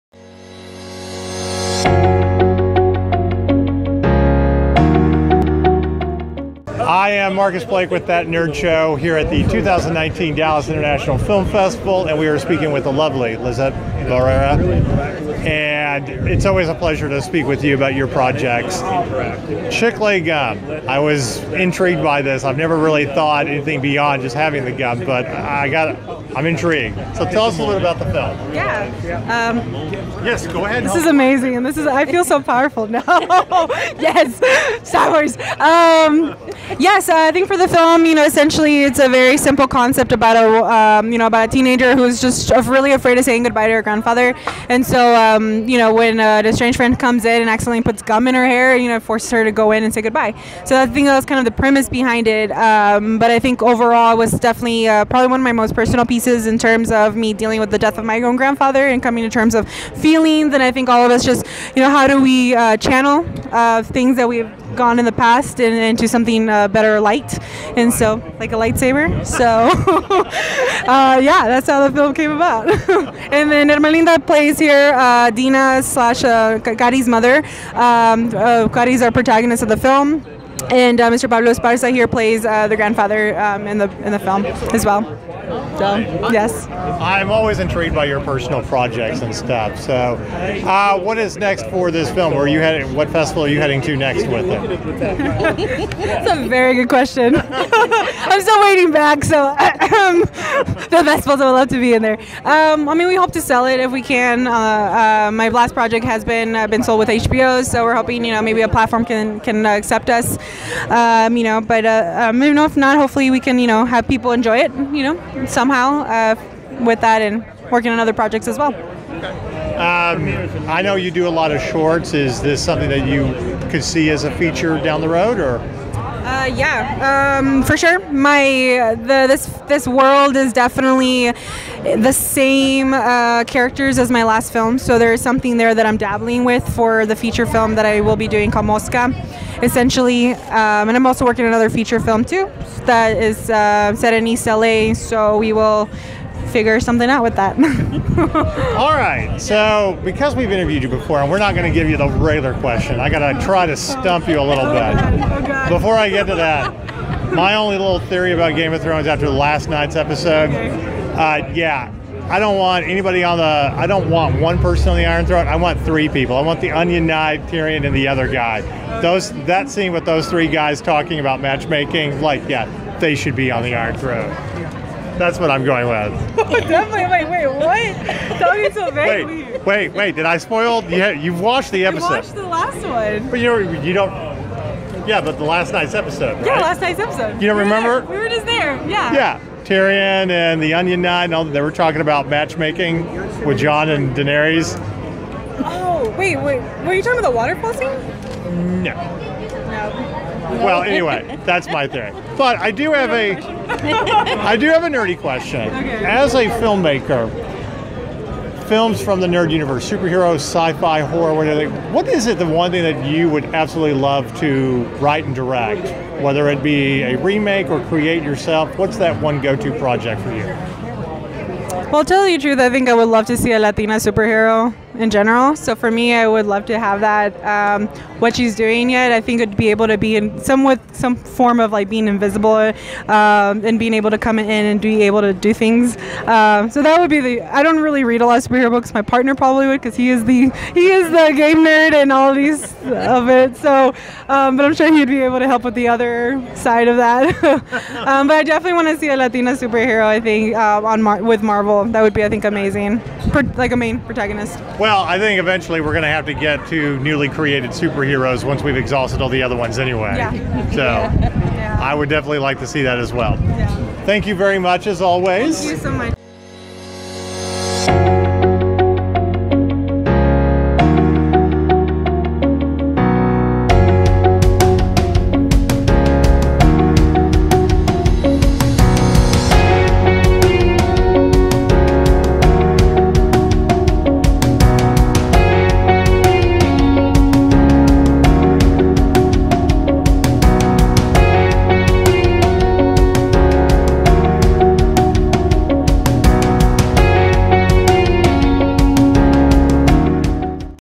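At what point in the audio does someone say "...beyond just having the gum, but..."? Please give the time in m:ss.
0:23.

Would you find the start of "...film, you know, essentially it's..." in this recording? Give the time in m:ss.
0:37.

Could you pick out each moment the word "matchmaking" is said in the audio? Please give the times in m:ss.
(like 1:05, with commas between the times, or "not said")
2:51, 3:12.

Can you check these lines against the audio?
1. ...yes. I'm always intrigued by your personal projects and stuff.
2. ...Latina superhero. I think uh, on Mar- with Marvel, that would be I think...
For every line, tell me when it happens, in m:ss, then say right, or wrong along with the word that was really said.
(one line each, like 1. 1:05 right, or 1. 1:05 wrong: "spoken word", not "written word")
1. 1:26 right
2. 4:09 right.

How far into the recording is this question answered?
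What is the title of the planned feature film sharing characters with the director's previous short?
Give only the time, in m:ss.
2:18.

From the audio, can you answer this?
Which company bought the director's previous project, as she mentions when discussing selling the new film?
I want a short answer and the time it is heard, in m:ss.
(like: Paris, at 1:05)
HBO, at 1:47.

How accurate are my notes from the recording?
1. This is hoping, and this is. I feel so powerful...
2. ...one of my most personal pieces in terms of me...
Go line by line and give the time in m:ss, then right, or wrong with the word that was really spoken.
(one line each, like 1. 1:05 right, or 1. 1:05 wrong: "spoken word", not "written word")
1. 0:30 wrong: "amazing", not "hoping"
2. 0:55 right.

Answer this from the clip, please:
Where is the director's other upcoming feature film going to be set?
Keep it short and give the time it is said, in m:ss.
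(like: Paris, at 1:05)
East LA, at 2:24.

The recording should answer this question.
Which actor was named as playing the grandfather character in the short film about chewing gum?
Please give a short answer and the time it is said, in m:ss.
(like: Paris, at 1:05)
Pablo Esparza, at 1:21.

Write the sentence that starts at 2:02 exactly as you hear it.
Is this something that you could see as a feature down the road, or?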